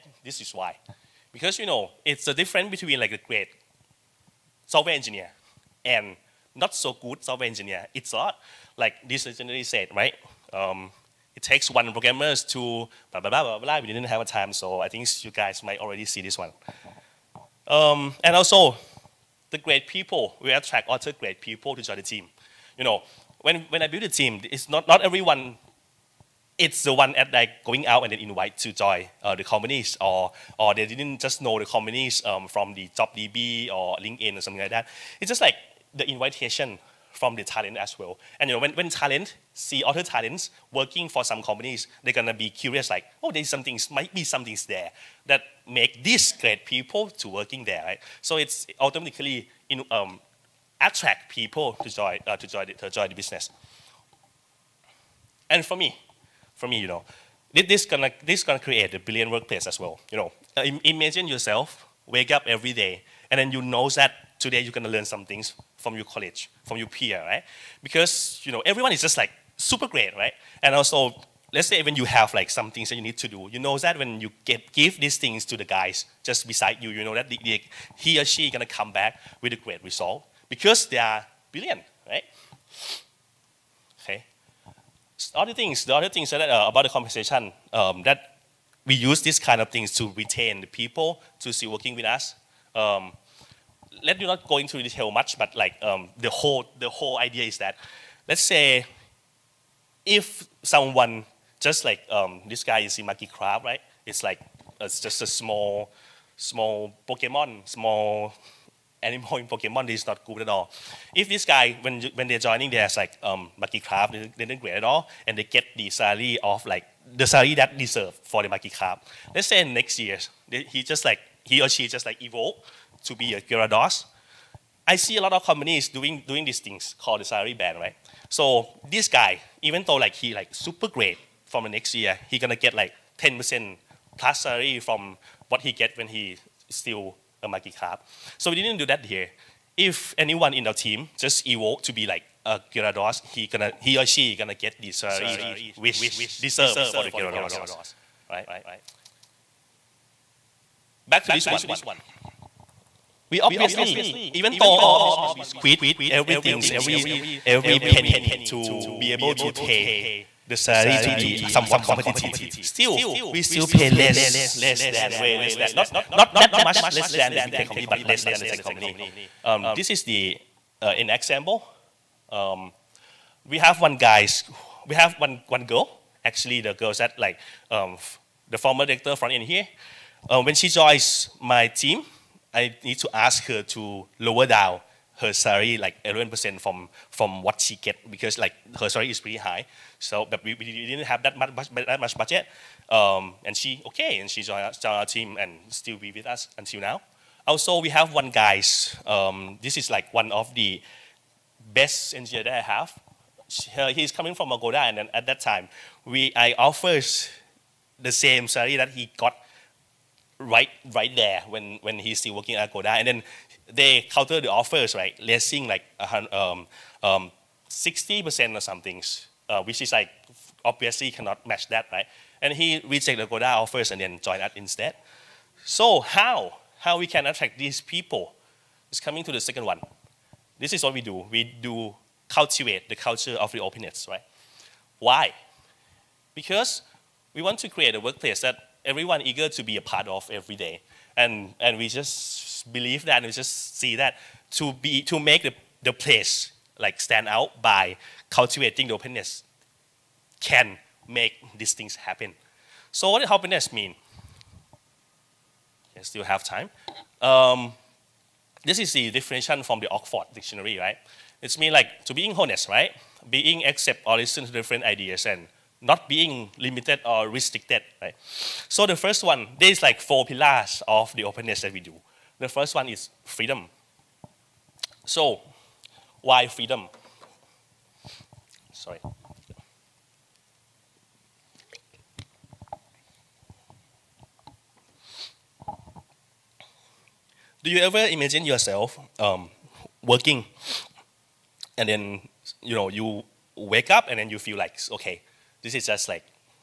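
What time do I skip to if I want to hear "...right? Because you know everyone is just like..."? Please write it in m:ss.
1:07.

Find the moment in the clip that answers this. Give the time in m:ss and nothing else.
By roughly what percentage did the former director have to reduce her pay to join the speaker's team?
3:06.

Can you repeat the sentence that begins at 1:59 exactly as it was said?
Let's say next year, they, he just like, he or she just like evolve to be a Gyarados.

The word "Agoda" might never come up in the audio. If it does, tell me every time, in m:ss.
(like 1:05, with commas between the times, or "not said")
3:24, 3:32, 3:43.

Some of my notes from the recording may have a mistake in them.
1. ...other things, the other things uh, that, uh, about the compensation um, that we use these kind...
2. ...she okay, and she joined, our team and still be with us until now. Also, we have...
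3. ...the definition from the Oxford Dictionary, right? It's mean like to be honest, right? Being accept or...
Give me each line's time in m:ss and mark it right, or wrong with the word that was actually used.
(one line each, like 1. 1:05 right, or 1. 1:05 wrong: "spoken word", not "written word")
1. 1:25 right
2. 3:13 right
3. 4:18 right.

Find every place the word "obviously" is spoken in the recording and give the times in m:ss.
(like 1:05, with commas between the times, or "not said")
2:33, 3:40.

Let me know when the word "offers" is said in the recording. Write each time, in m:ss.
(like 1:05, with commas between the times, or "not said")
3:26, 3:34, 3:43.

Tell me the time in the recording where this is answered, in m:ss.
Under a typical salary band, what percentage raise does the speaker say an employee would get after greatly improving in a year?
2:13.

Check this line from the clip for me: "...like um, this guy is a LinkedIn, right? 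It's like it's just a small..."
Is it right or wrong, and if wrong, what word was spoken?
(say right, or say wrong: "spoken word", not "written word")
wrong: "Magikarp", not "LinkedIn".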